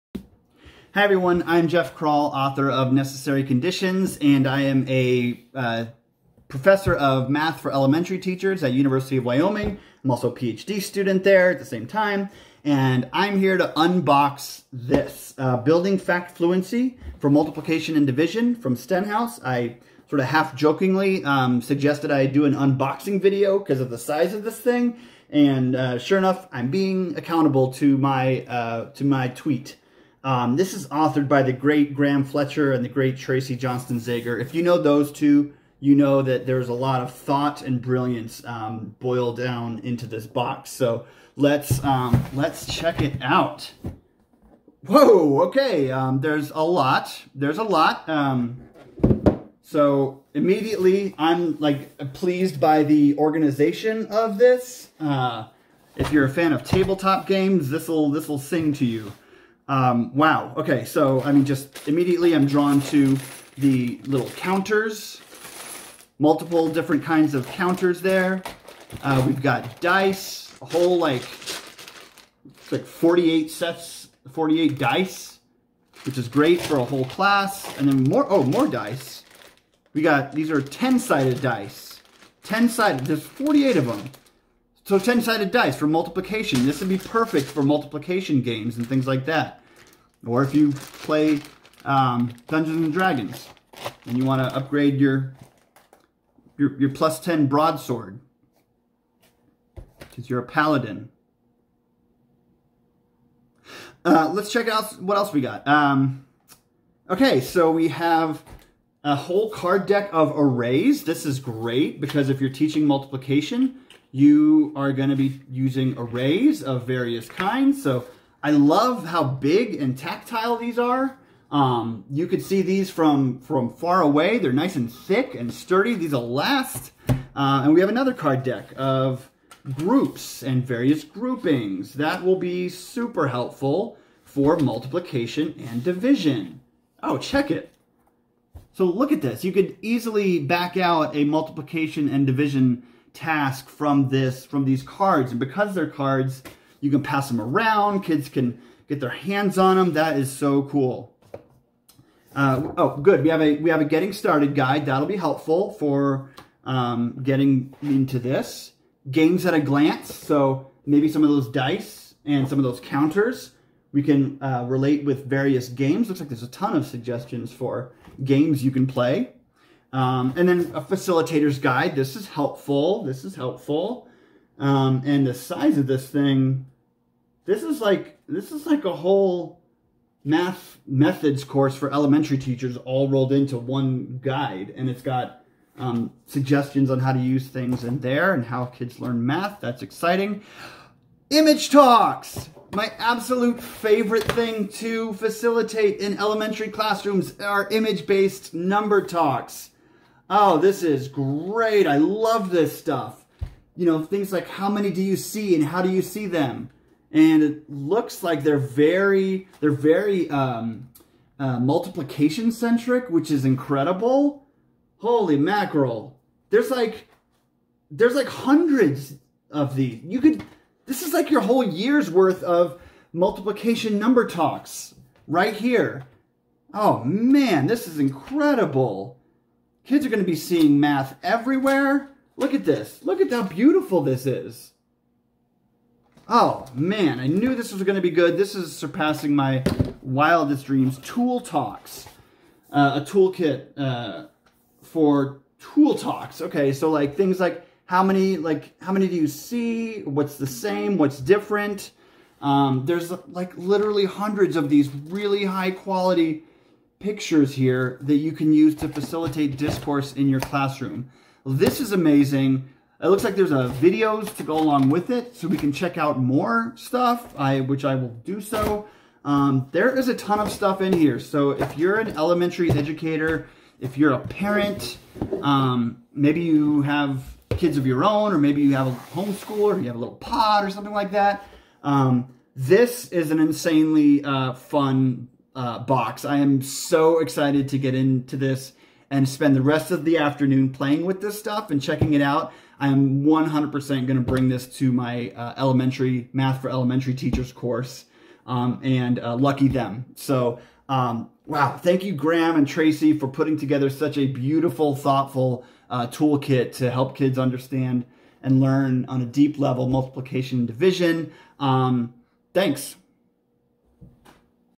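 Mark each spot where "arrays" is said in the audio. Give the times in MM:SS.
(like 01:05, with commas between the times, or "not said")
01:50, 01:55.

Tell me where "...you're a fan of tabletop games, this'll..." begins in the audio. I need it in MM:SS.
00:56.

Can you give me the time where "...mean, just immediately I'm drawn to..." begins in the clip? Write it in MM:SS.
01:01.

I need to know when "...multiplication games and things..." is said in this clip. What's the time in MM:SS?
01:27.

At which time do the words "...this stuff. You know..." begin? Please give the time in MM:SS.
03:22.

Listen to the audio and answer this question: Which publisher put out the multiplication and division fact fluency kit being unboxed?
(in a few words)
Stenhouse.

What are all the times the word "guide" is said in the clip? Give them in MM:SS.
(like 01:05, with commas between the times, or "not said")
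02:34, 02:51, 03:04.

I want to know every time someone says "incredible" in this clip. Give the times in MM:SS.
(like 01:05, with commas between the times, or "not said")
03:33, 03:47.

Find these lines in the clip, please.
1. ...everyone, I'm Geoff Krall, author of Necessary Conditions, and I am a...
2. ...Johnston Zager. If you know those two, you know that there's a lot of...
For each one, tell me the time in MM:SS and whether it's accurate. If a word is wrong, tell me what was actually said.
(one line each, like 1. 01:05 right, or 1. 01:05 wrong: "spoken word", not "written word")
1. 00:01 right
2. 00:33 right.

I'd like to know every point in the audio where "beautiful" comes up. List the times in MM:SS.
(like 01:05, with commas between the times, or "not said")
03:53, 05:04.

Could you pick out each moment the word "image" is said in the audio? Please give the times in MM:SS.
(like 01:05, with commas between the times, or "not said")
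03:11, 03:17.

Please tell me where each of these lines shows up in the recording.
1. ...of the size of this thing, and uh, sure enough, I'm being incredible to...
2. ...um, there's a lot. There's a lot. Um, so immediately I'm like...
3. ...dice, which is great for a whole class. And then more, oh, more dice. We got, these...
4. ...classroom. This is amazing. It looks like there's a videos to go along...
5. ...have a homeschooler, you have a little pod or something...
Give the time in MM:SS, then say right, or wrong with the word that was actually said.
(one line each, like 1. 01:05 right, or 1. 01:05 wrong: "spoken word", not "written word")
1. 00:23 wrong: "accountable", not "incredible"
2. 00:45 right
3. 01:14 right
4. 04:20 right
5. 04:38 right.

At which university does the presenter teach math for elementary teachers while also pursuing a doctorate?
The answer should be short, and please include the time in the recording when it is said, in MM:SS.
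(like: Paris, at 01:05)
University of Wyoming, at 00:08.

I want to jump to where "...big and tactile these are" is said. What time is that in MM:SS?
01:59.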